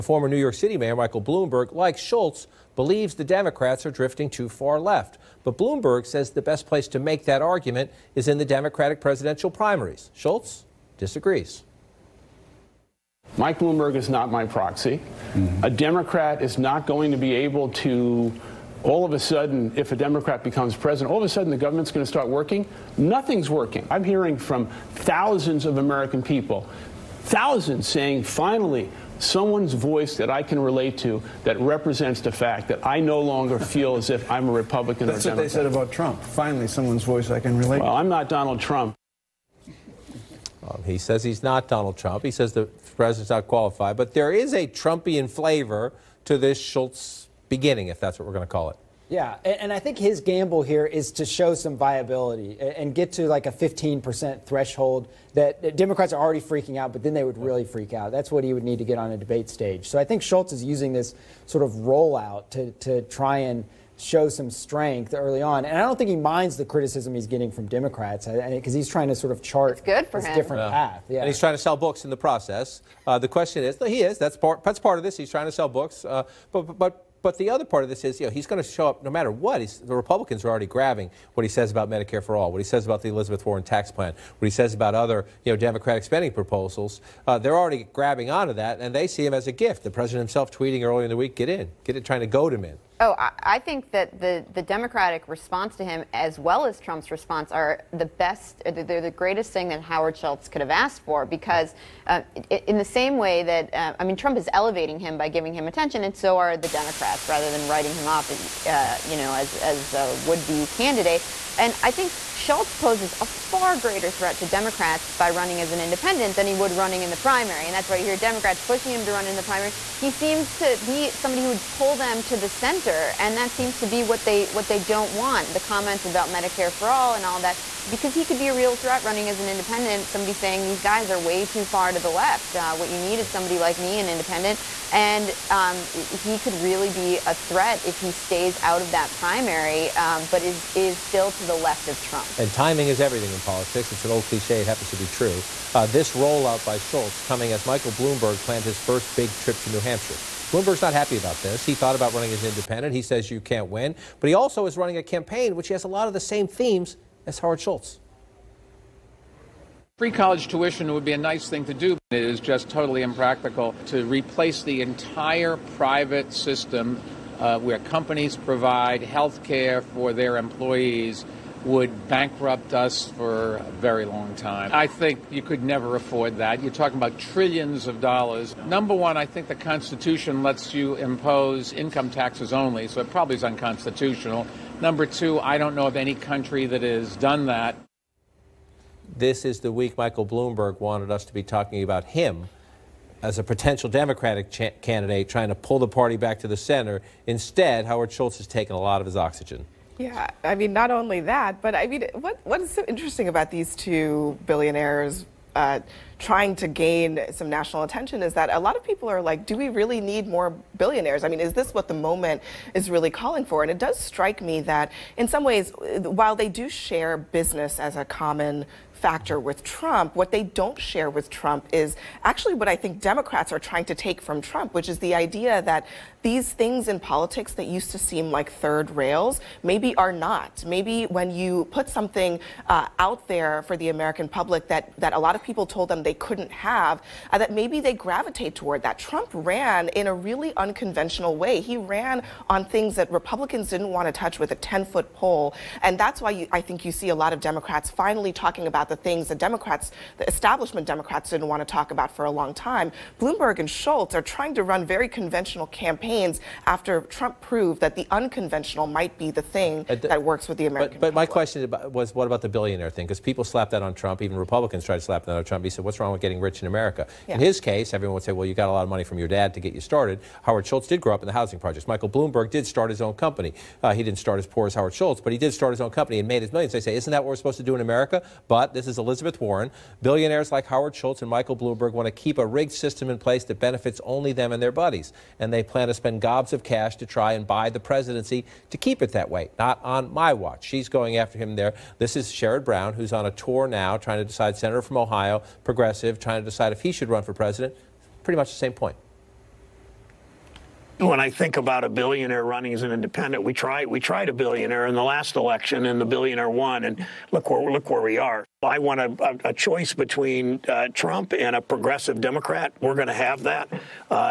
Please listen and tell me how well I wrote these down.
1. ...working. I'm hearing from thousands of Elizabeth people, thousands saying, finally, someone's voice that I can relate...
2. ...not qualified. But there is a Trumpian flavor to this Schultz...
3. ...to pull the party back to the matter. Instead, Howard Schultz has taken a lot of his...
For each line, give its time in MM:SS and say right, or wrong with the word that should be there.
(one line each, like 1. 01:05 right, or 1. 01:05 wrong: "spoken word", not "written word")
1. 00:23 wrong: "American", not "Elizabeth"
2. 00:43 right
3. 03:15 wrong: "center", not "matter".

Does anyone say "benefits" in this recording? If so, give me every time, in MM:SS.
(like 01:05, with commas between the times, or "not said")
04:43.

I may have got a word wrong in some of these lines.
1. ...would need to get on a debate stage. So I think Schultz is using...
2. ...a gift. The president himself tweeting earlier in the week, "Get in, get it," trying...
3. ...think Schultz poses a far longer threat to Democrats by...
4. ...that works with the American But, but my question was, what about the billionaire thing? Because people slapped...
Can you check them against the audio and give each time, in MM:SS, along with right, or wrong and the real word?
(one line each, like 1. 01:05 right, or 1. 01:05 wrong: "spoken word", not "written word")
1. 00:58 right
2. 01:29 right
3. 01:51 wrong: "greater", not "longer"
4. 04:19 right.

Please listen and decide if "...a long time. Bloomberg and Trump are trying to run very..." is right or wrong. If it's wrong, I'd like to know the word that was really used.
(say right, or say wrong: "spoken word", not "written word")
wrong: "Schultz", not "Trump".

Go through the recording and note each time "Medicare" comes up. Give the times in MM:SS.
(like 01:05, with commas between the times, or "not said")
01:21, 02:06.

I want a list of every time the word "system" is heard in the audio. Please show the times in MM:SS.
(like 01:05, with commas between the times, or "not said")
02:46, 04:42.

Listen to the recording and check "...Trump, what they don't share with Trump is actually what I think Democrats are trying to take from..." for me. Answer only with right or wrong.
right.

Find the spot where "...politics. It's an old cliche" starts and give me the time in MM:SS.
02:23.